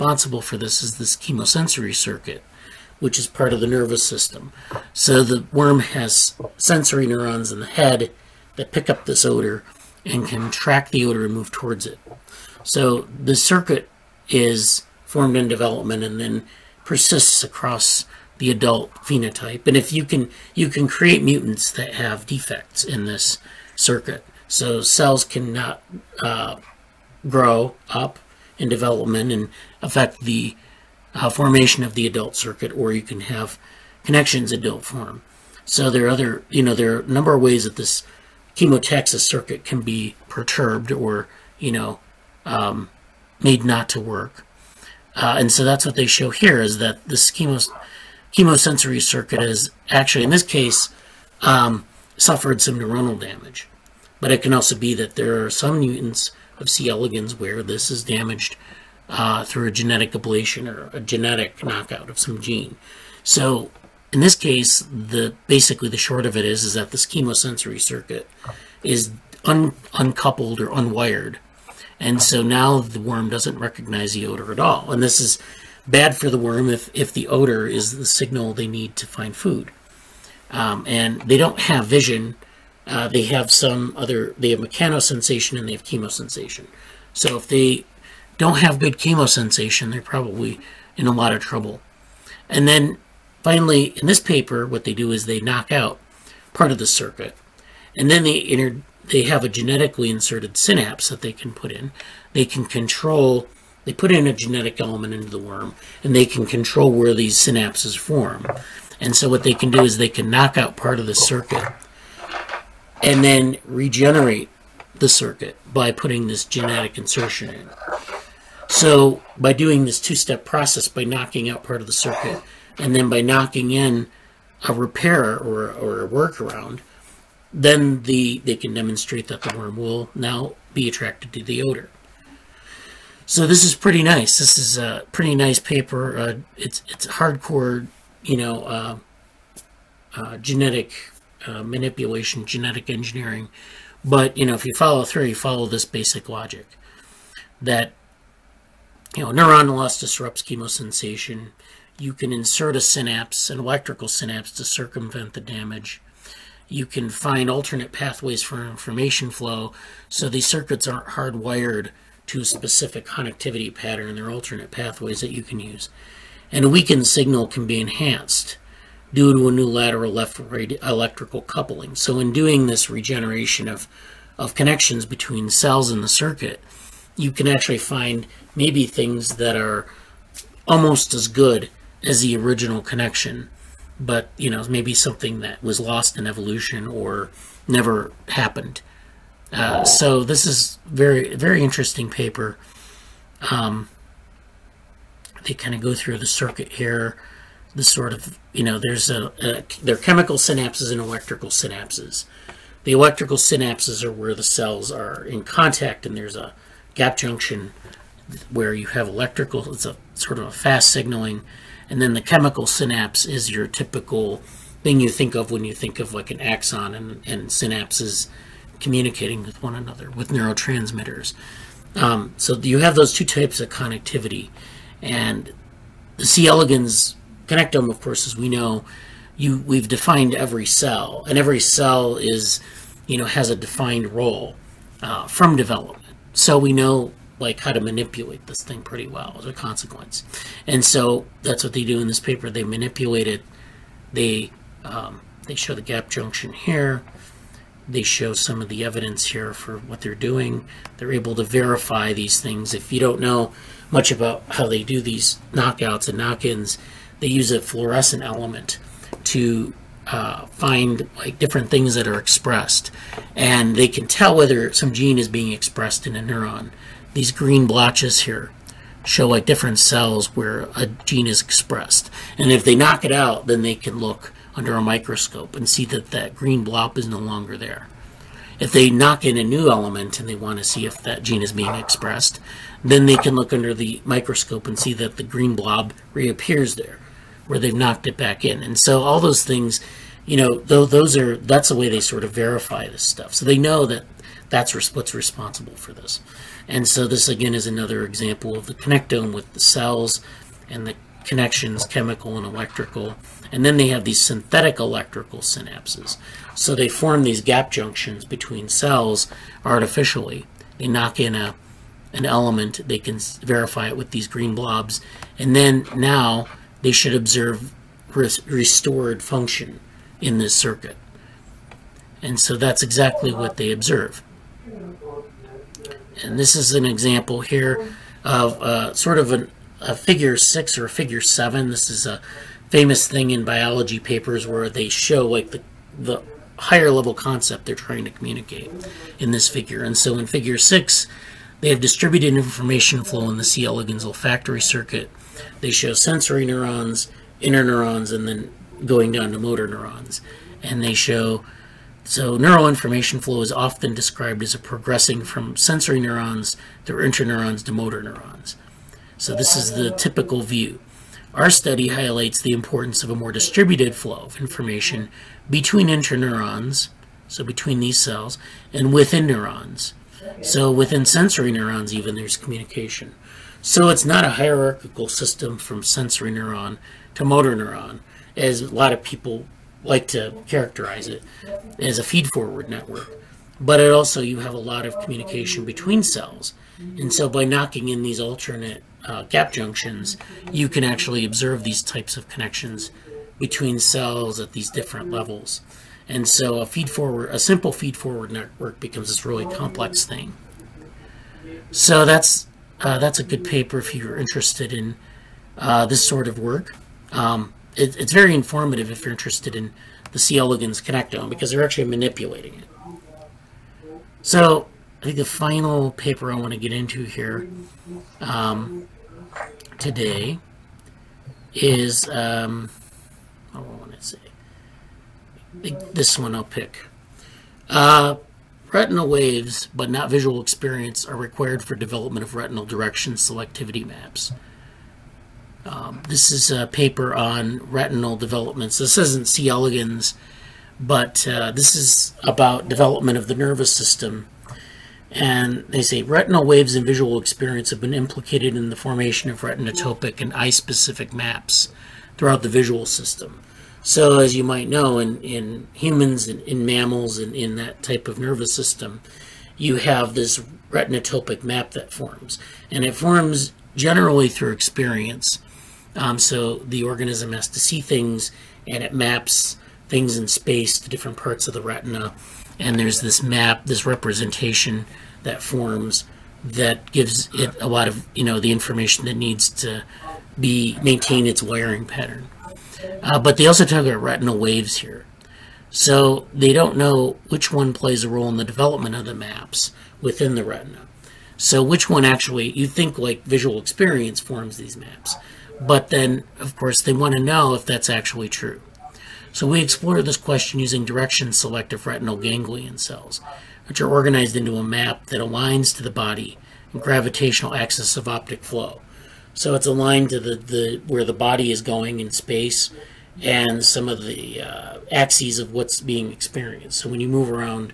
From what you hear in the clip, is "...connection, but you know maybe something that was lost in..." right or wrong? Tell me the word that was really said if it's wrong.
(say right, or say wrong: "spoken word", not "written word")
right.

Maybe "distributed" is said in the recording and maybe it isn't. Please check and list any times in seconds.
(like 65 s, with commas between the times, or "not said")
341 s, 363 s.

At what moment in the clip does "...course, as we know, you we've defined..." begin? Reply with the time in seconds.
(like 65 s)
227 s.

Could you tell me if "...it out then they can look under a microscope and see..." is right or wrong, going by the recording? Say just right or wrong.
right.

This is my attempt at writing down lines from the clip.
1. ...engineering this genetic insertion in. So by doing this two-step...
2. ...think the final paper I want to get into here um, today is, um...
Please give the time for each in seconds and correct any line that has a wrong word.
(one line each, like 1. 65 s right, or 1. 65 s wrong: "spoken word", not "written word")
1. 115 s wrong: "putting", not "engineering"
2. 415 s right.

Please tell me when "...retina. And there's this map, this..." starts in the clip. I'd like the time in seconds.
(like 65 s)
471 s.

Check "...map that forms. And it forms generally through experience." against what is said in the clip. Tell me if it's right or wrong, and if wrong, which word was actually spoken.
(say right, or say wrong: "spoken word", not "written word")
right.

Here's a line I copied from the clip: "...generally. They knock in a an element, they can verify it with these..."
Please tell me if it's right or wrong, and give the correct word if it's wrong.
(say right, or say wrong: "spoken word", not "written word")
wrong: "artificially", not "generally".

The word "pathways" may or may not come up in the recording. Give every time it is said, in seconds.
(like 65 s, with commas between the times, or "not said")
157 s, 164 s.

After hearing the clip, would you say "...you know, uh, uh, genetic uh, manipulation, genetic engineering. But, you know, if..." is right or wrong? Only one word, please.
right.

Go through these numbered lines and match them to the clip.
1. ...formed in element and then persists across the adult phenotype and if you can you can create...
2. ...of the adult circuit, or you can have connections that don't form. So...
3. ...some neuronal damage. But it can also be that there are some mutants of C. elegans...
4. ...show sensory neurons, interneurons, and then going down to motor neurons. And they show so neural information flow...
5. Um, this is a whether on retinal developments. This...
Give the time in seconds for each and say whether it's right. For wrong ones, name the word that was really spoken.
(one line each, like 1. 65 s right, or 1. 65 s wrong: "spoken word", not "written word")
1. 15 s wrong: "development", not "element"
2. 31 s right
3. 52 s right
4. 345 s right
5. 435 s wrong: "paper", not "whether".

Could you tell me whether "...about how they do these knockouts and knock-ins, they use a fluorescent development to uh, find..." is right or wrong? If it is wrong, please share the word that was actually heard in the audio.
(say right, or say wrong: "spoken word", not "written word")
wrong: "element", not "development".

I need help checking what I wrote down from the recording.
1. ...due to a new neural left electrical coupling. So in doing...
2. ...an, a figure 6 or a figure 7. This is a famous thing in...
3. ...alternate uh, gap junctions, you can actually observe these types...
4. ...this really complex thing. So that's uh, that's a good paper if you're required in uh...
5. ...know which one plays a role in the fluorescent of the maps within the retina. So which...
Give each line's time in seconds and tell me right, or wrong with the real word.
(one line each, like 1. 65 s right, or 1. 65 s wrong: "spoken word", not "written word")
1. 169 s wrong: "lateral", not "neural"
2. 329 s right
3. 388 s right
4. 399 s wrong: "interested", not "required"
5. 486 s wrong: "development", not "fluorescent".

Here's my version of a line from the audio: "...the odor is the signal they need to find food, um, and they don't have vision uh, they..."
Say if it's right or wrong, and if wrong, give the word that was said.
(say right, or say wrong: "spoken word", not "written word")
right.